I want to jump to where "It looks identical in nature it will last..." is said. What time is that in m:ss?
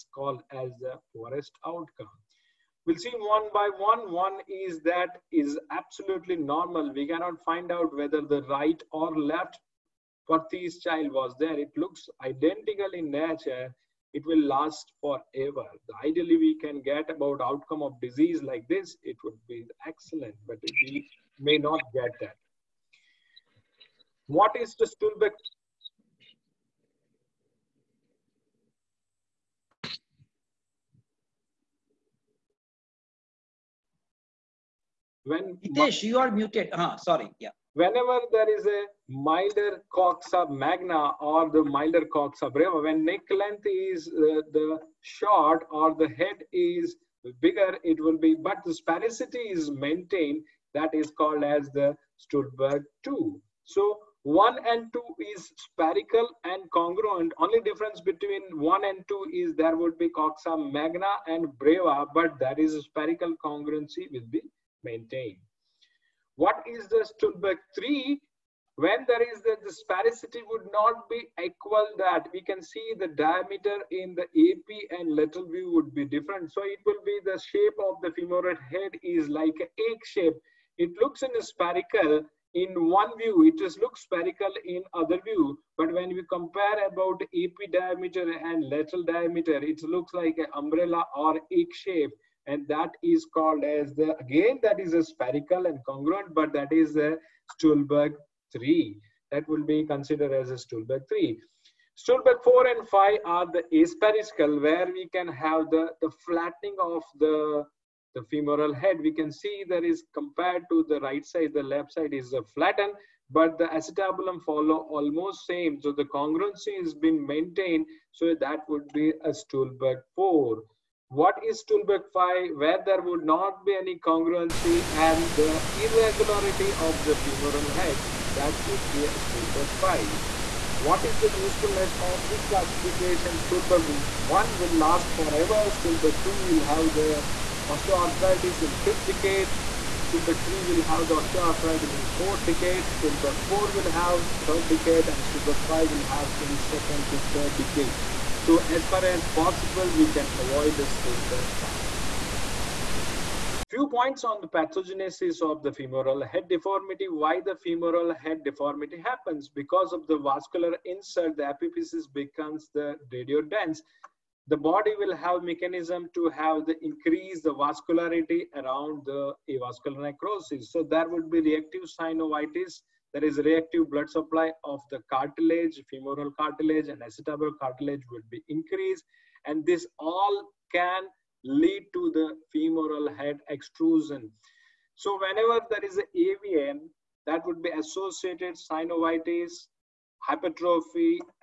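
0:11.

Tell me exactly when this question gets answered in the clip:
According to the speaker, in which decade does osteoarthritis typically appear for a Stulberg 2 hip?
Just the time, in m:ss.
2:18.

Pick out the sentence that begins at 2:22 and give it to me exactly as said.
Stulberg 4 will have third decade and Stulberg 5 will have in second to third decade.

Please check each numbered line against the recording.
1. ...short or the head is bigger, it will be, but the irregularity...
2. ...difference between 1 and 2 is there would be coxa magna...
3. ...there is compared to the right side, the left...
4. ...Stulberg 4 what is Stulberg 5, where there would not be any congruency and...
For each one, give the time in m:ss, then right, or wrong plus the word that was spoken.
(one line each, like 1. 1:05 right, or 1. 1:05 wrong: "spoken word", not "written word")
1. 0:44 wrong: "sphericity", not "irregularity"
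2. 0:57 right
3. 1:49 right
4. 1:59 right.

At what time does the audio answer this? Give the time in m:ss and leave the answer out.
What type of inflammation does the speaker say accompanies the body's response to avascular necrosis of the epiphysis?
2:51.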